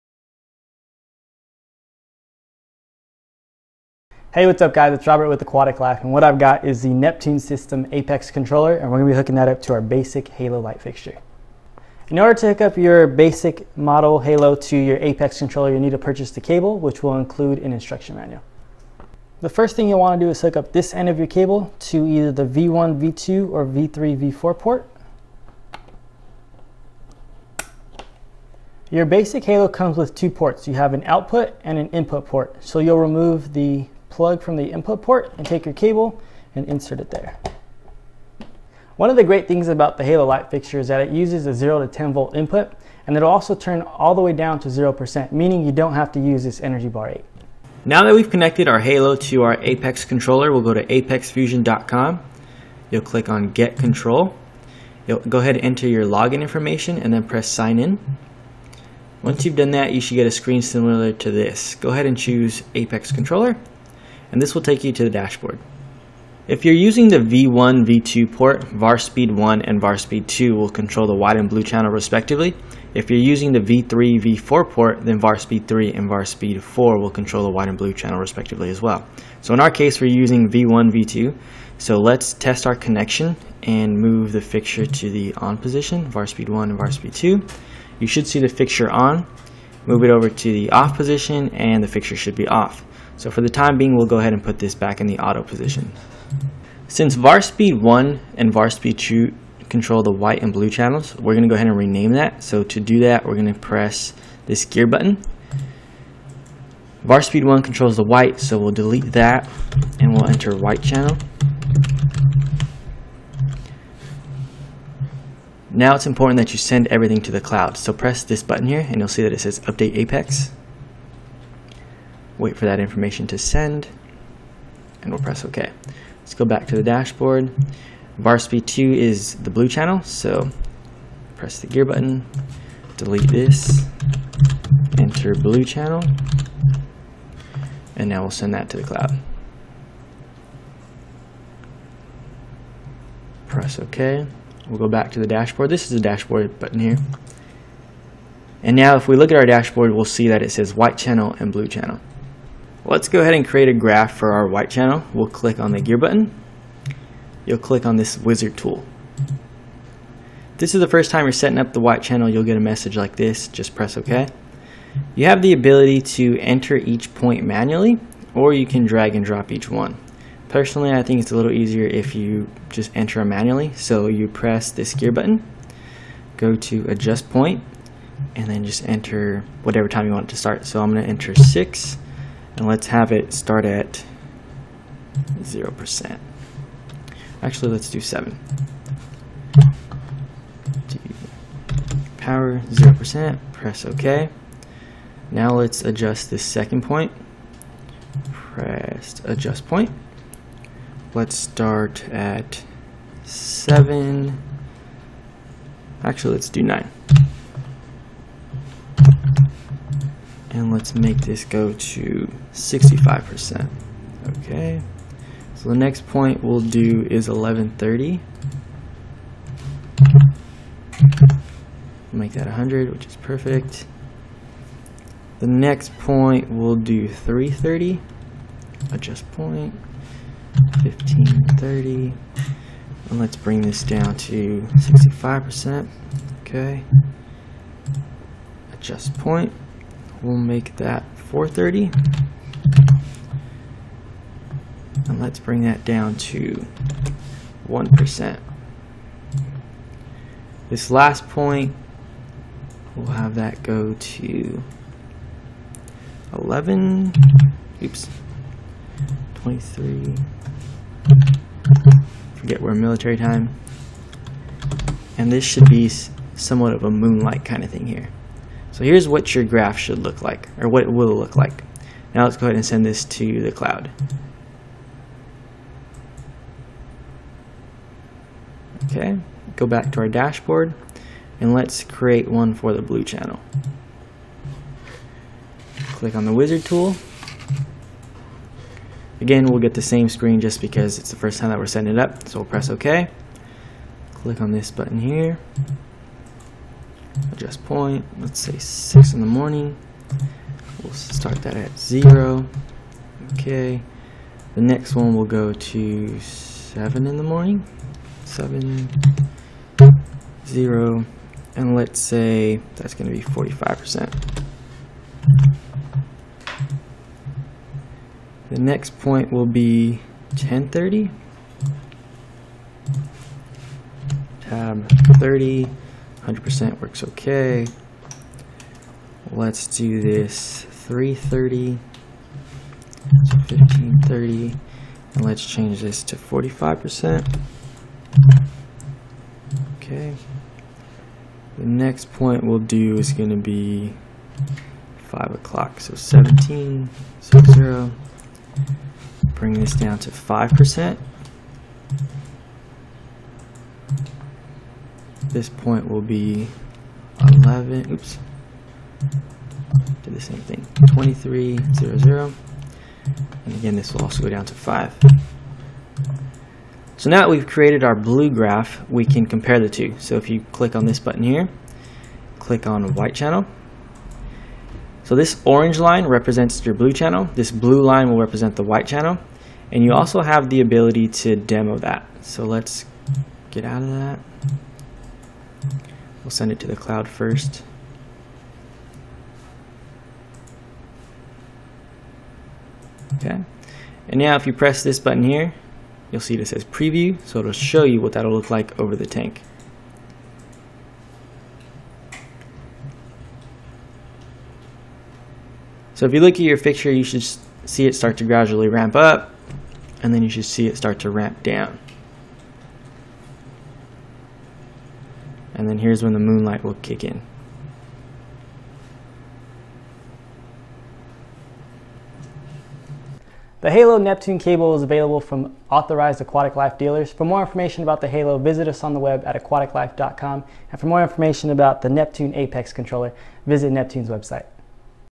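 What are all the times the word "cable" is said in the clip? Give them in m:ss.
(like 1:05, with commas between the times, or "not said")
0:16, 0:21, 0:35, 7:04.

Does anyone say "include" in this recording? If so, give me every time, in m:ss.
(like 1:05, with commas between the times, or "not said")
0:17.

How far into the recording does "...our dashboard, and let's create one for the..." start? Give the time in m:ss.
4:39.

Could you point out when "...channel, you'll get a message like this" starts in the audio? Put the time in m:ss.
2:42.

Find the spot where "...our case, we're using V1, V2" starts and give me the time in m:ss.
1:19.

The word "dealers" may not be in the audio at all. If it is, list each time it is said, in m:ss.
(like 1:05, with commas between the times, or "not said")
7:06.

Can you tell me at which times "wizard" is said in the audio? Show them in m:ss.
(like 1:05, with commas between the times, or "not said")
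2:38, 4:46.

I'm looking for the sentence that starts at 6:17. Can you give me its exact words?
This blue line will represent the white channel.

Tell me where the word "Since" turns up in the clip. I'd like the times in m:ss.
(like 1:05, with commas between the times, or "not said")
1:36.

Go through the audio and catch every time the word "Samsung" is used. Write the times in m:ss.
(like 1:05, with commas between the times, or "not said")
not said.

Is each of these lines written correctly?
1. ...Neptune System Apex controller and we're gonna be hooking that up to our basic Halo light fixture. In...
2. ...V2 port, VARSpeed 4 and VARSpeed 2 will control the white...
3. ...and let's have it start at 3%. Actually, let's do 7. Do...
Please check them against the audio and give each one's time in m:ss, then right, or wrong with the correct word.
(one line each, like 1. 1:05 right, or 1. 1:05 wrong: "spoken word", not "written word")
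1. 0:06 right
2. 1:07 wrong: "1", not "4"
3. 3:02 wrong: "0", not "3".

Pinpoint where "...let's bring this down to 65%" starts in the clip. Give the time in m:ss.
3:53.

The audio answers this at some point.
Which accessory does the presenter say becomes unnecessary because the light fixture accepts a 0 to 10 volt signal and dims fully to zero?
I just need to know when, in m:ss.
0:46.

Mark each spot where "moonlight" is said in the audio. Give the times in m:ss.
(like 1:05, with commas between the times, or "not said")
4:26, 6:56.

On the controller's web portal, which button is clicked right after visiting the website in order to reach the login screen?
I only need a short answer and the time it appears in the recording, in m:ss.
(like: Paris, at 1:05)
Get Control, at 0:53.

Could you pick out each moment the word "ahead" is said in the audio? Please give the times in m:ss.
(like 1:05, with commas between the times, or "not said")
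0:55, 1:01, 1:34, 1:41, 2:33, 4:32.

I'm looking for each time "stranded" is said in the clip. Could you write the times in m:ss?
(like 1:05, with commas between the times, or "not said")
not said.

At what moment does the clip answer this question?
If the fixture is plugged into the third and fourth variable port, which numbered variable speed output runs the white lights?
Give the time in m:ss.
1:15.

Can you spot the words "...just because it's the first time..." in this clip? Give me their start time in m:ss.
4:50.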